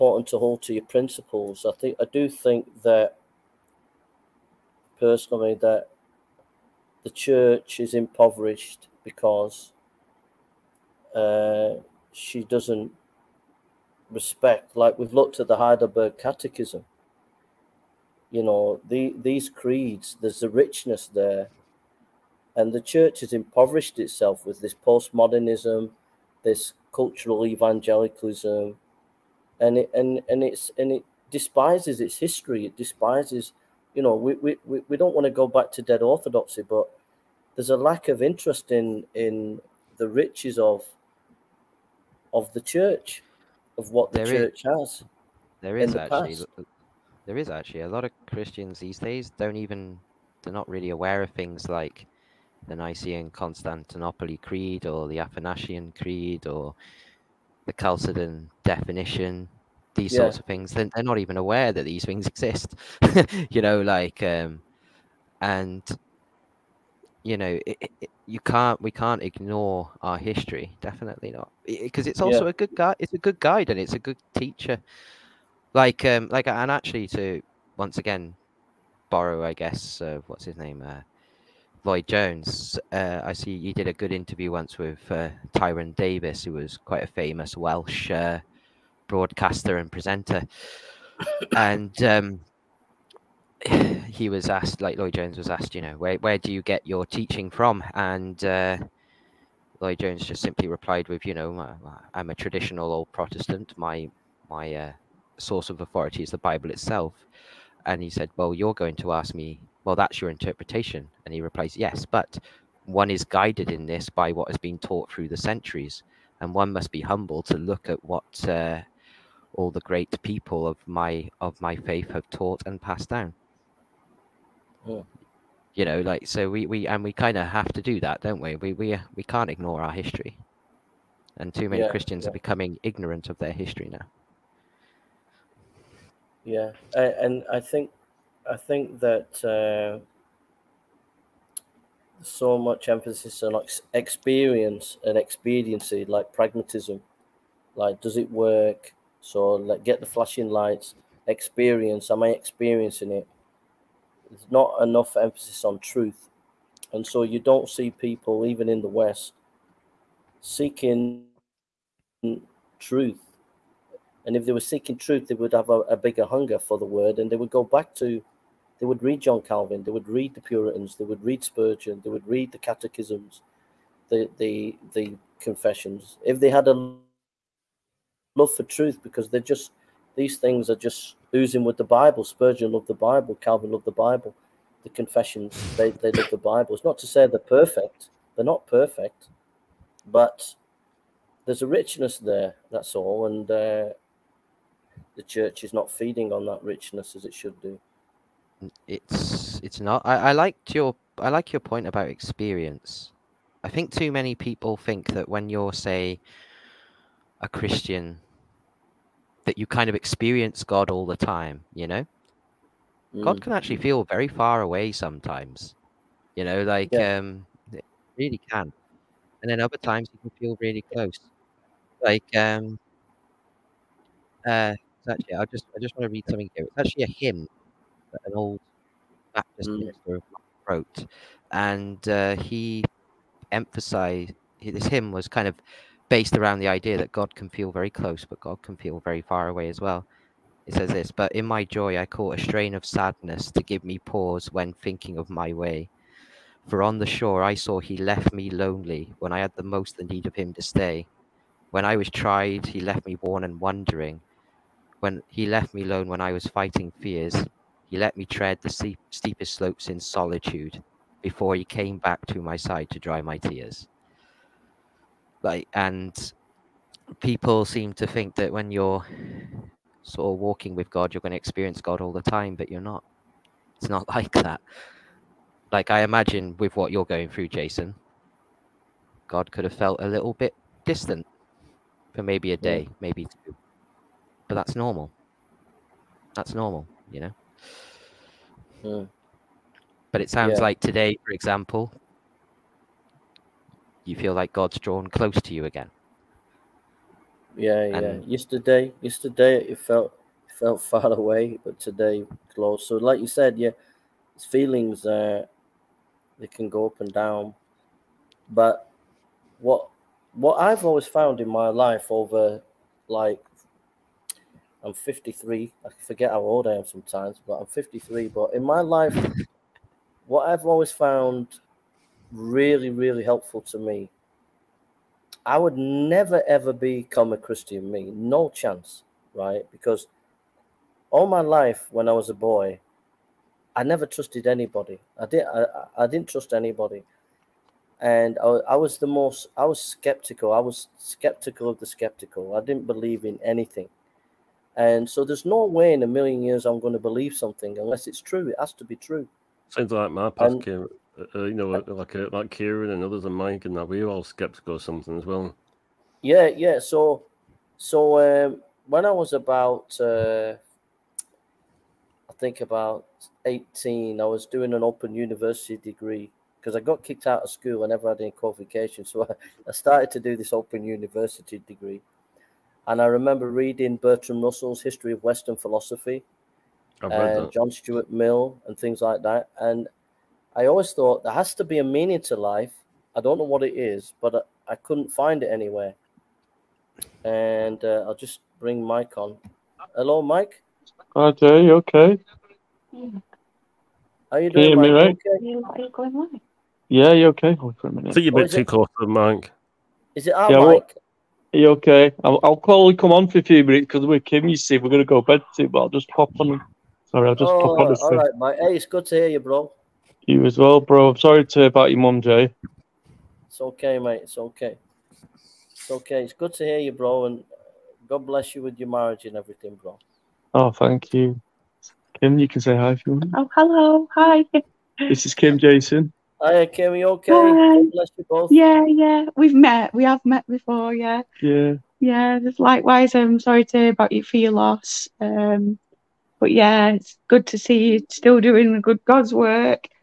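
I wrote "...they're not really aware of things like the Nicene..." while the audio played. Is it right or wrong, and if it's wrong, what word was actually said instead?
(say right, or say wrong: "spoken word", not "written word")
right.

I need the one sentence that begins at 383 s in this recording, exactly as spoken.
I don't know what it is, but I, I couldn't find it anywhere.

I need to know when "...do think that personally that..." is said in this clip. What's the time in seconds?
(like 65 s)
2 s.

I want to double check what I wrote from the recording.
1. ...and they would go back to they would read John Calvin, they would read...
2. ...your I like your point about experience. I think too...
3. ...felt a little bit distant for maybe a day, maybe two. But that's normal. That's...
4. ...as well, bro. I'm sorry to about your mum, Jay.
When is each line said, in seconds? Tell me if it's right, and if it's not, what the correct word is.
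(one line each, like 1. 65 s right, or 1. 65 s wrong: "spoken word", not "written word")
1. 167 s right
2. 200 s right
3. 279 s right
4. 410 s right.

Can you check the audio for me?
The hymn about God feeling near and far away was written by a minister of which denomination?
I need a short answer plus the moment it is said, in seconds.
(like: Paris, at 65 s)
Baptist, at 229 s.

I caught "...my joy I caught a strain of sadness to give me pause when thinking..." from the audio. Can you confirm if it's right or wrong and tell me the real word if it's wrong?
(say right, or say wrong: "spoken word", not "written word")
right.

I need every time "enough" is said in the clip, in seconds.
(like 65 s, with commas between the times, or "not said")
154 s.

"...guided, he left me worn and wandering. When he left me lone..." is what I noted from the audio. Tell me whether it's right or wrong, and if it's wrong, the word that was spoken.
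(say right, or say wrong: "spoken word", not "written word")
wrong: "tried", not "guided".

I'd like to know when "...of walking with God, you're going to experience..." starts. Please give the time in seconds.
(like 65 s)
270 s.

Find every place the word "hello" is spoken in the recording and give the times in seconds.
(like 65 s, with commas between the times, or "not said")
389 s, 423 s.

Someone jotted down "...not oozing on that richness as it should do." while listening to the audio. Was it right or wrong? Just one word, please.
wrong.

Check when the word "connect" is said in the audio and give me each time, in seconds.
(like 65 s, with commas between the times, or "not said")
not said.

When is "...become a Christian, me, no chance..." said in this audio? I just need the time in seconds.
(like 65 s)
326 s.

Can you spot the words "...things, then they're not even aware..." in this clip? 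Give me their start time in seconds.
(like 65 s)
60 s.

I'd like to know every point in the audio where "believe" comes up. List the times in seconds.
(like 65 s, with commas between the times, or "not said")
342 s, 346 s.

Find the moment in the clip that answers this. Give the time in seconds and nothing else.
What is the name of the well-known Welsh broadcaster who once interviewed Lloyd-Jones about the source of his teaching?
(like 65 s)
85 s.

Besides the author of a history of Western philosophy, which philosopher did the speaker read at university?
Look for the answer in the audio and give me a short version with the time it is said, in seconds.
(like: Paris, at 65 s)
John Stuart Mill, at 377 s.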